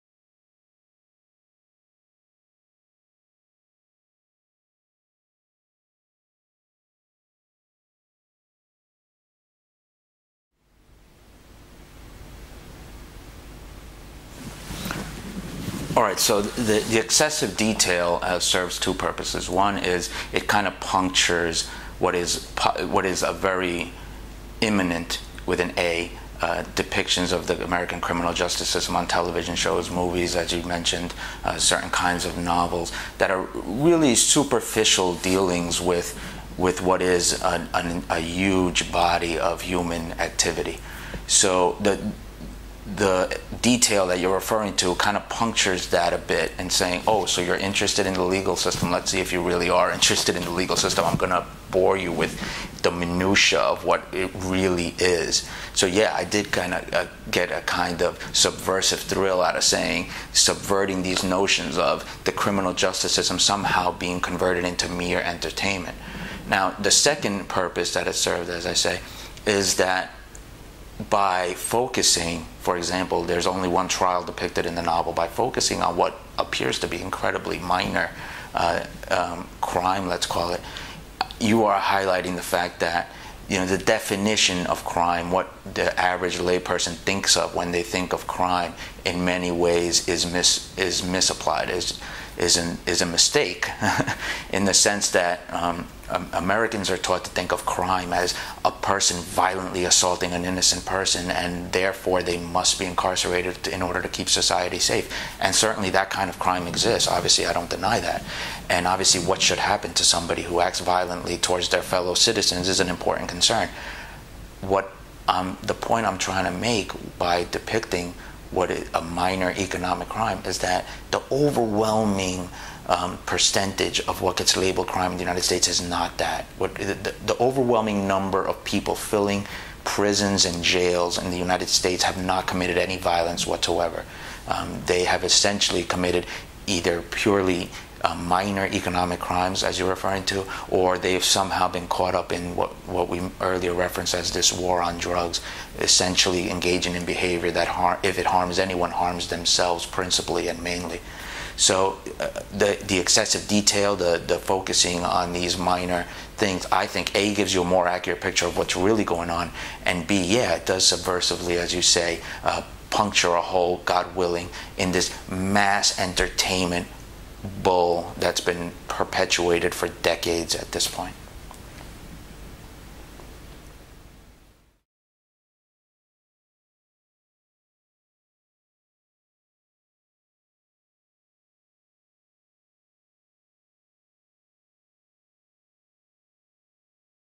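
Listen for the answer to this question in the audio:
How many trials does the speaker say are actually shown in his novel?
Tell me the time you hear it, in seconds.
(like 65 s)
73 s.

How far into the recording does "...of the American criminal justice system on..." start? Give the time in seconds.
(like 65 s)
27 s.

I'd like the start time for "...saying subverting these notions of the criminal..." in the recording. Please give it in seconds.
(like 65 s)
59 s.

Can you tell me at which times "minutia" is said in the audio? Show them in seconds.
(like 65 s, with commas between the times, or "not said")
52 s.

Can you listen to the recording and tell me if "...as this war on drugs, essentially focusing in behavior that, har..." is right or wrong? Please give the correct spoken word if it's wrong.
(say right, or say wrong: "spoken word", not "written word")
wrong: "engaging", not "focusing".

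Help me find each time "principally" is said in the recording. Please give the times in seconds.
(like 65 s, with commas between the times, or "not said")
149 s.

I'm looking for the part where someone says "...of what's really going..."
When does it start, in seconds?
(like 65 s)
158 s.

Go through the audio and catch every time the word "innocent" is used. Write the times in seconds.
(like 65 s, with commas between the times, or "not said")
100 s.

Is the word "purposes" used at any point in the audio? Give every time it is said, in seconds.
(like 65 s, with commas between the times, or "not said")
18 s, 67 s.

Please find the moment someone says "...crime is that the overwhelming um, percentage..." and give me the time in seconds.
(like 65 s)
120 s.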